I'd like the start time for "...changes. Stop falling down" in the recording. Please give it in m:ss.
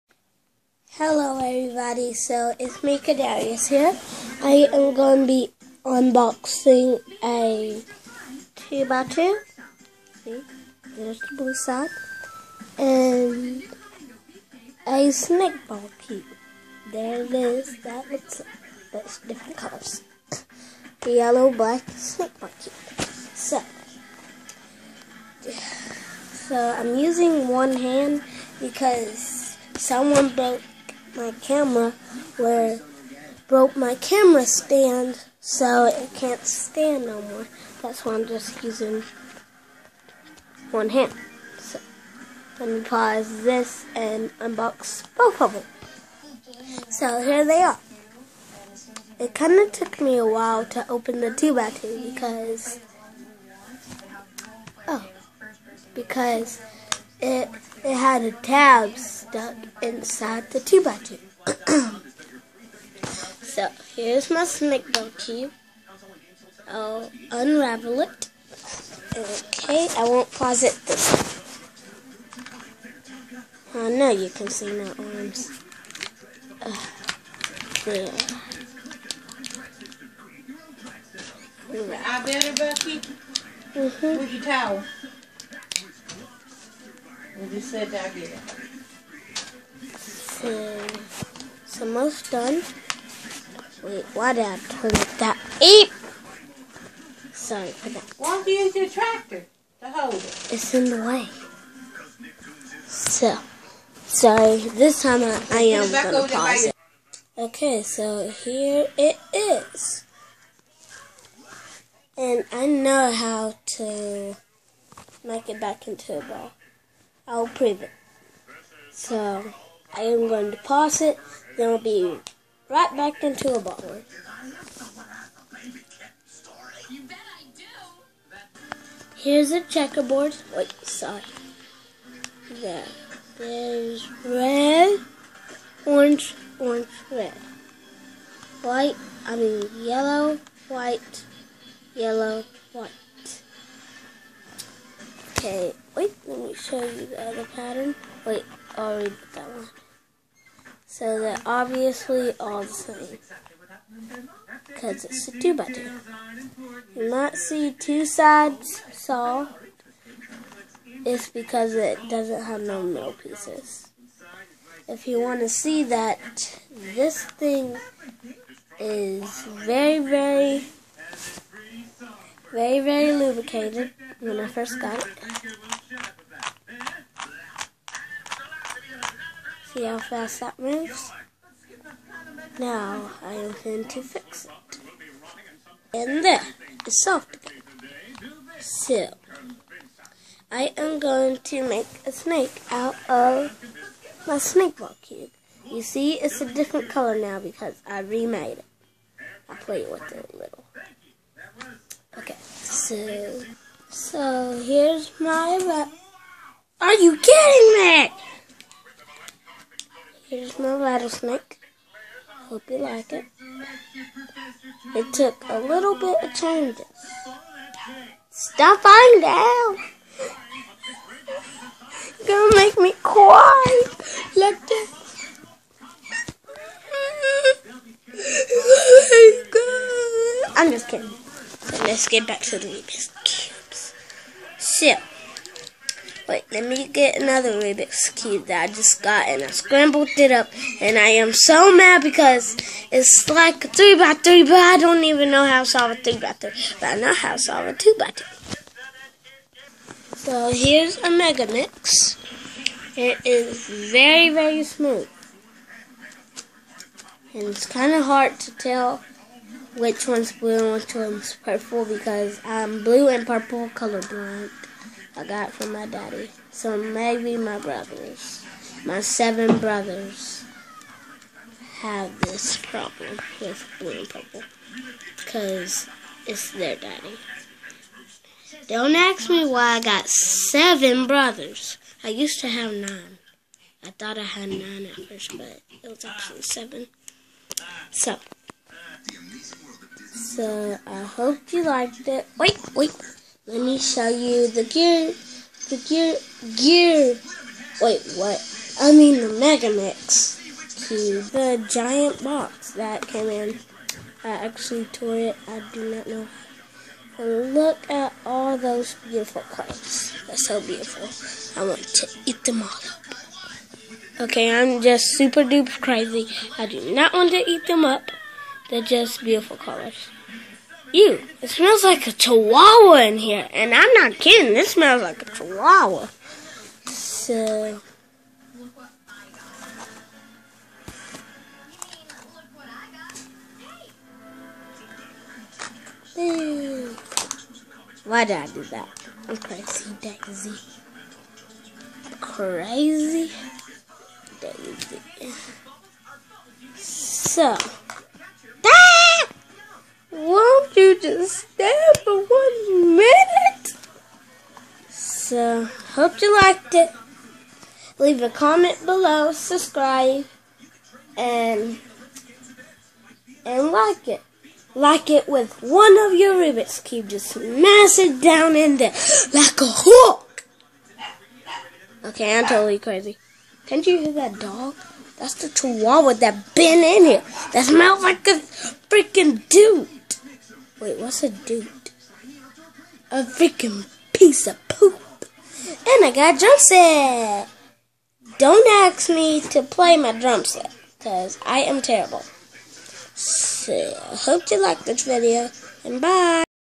3:36.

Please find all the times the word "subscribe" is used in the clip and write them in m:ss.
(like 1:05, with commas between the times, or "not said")
5:59.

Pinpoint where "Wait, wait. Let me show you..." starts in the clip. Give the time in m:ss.
4:52.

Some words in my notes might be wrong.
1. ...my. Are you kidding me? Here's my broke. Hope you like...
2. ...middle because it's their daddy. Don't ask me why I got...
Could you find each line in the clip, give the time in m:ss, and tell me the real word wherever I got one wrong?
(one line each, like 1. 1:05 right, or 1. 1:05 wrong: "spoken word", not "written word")
1. 3:25 wrong: "rattlesnake", not "broke"
2. 4:34 wrong: "purple", not "middle".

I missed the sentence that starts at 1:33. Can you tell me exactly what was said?
Wait, why did I turn it that?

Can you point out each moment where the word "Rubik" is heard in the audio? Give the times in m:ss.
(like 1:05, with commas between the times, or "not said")
3:52, 3:57, 6:06.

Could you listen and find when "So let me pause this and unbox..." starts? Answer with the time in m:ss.
0:41.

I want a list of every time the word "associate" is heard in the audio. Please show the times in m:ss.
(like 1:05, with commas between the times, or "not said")
not said.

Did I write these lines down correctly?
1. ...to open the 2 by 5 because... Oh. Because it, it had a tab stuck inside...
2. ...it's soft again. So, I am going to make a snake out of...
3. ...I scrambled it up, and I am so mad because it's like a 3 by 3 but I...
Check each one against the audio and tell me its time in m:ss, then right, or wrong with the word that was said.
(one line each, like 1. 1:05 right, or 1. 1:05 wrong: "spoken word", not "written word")
1. 0:50 wrong: "2", not "5"
2. 3:06 right
3. 3:59 right.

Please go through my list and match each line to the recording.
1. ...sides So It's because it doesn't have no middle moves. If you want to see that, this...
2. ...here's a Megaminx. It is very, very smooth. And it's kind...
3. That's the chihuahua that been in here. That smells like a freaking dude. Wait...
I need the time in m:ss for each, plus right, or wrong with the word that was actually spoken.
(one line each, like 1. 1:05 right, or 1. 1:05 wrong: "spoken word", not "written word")
1. 2:38 wrong: "pieces", not "moves"
2. 4:10 right
3. 6:15 right.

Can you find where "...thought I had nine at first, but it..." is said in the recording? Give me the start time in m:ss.
4:43.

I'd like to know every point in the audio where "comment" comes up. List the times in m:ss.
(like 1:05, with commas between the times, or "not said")
5:58.